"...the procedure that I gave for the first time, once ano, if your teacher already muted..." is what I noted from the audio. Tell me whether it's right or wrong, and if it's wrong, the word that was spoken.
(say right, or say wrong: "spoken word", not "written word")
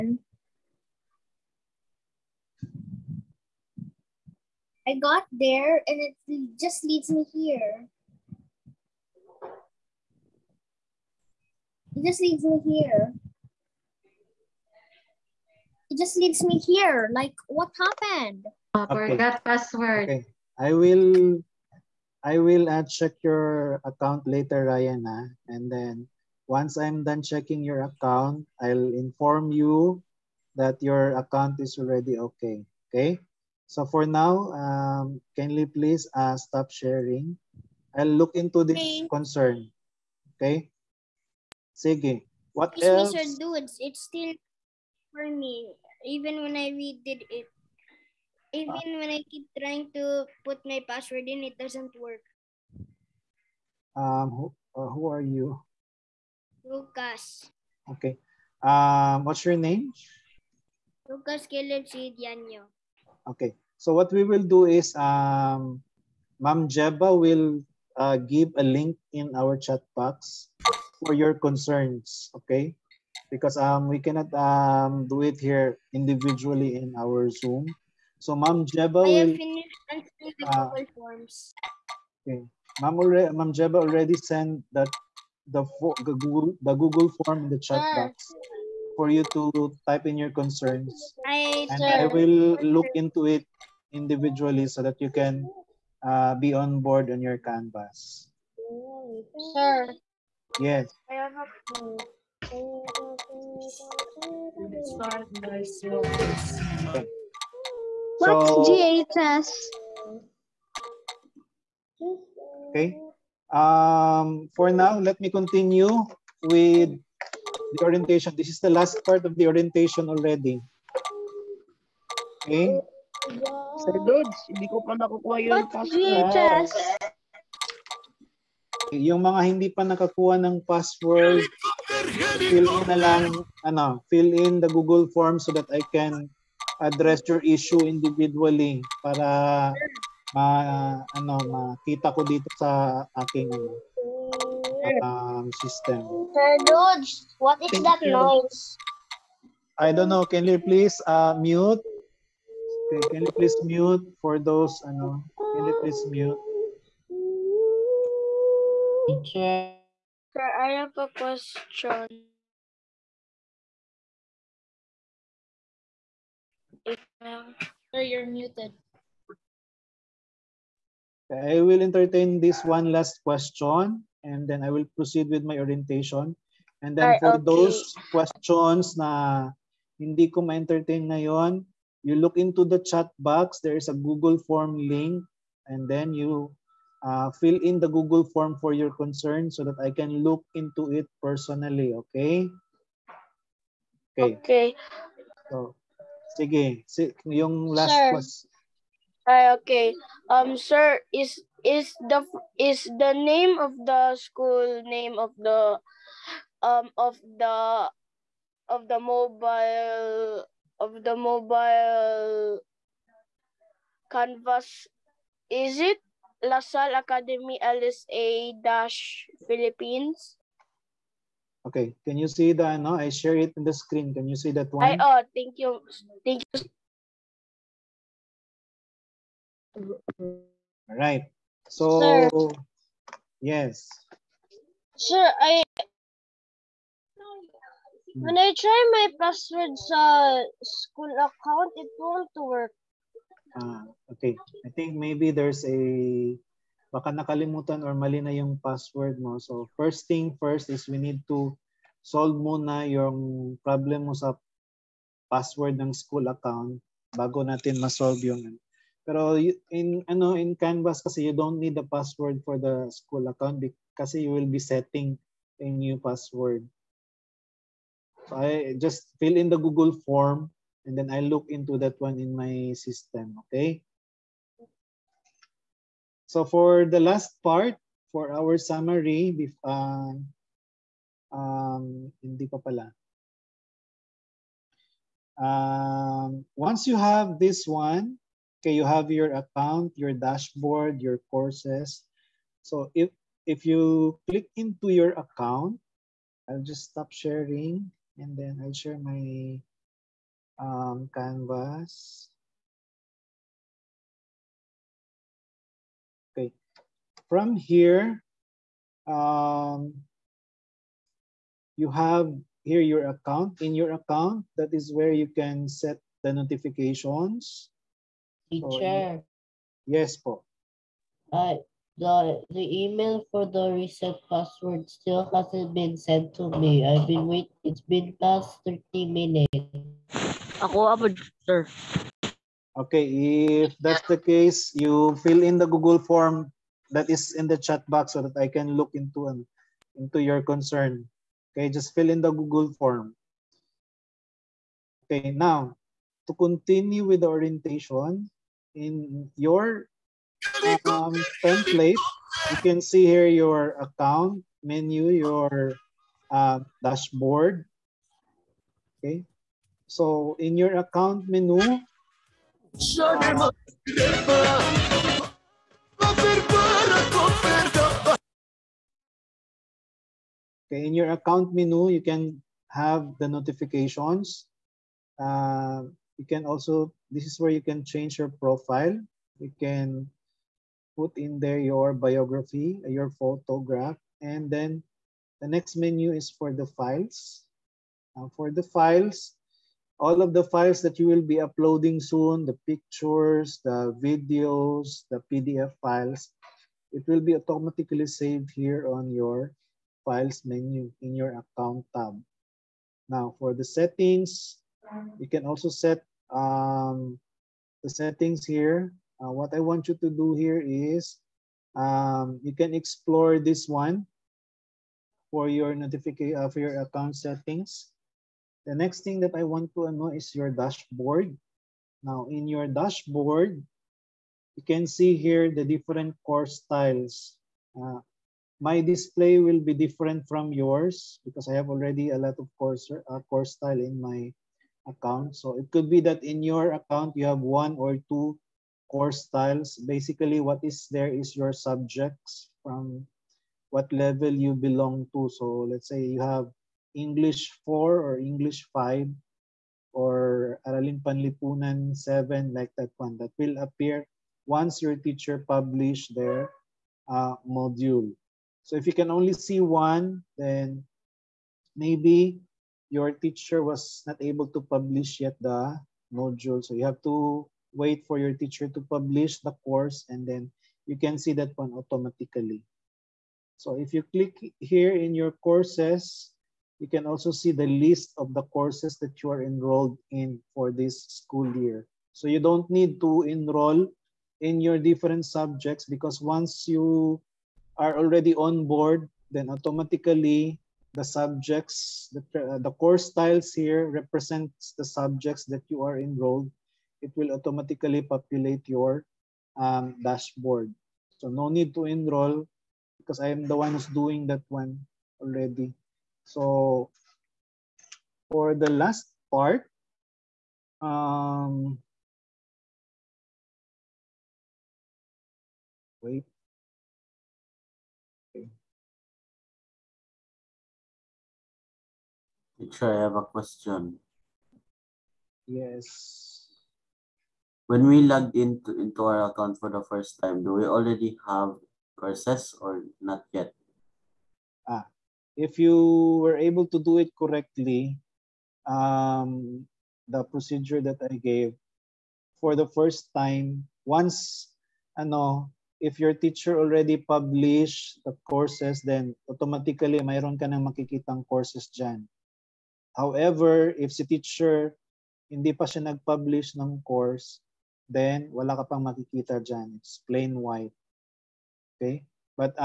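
wrong: "published", not "muted".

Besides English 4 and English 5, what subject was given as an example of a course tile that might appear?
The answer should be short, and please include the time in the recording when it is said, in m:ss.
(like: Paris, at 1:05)
Araling Panlipunan 7, at 7:30.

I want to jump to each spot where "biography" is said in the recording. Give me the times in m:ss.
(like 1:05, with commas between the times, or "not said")
6:21.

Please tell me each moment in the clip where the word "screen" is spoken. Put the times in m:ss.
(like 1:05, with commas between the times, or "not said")
3:43.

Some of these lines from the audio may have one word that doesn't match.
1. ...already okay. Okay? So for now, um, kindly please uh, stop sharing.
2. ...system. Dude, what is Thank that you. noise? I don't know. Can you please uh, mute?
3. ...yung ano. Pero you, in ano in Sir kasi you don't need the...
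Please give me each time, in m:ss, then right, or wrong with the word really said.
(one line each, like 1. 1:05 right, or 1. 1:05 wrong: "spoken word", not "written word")
1. 0:31 right
2. 2:25 right
3. 4:18 wrong: "Canvas", not "Sir".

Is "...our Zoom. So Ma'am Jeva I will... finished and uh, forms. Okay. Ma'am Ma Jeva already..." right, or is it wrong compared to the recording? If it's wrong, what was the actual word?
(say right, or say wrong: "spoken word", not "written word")
right.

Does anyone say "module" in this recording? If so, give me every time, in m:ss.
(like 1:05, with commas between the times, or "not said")
7:37, 7:46.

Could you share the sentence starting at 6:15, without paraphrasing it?
Uh, you can also, this is where you can change your profile.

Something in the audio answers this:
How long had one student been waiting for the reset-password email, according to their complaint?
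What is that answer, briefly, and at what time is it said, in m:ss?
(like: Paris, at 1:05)
past 30 minutes, at 5:28.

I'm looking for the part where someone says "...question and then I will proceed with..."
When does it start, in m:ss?
2:53.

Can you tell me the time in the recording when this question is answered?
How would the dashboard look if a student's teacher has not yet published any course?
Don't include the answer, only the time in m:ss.
9:20.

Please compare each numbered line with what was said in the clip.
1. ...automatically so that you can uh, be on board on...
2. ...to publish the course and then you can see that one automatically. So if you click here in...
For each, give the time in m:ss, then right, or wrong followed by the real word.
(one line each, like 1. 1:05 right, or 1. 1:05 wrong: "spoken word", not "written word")
1. 1:33 wrong: "individually", not "automatically"
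2. 7:48 right.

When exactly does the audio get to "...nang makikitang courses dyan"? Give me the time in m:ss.
9:10.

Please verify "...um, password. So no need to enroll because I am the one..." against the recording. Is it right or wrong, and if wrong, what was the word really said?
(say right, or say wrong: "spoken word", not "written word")
wrong: "dashboard", not "password".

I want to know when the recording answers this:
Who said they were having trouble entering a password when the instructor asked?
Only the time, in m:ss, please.
1:01.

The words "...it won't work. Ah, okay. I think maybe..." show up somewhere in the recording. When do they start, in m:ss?
4:01.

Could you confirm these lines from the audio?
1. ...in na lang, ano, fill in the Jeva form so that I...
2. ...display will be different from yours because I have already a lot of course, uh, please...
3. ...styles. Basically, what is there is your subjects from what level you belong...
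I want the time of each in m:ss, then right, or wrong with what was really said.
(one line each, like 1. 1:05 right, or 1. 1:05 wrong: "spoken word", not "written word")
1. 2:12 wrong: "Google", not "Jeva"
2. 7:08 wrong: "course", not "please"
3. 7:19 right.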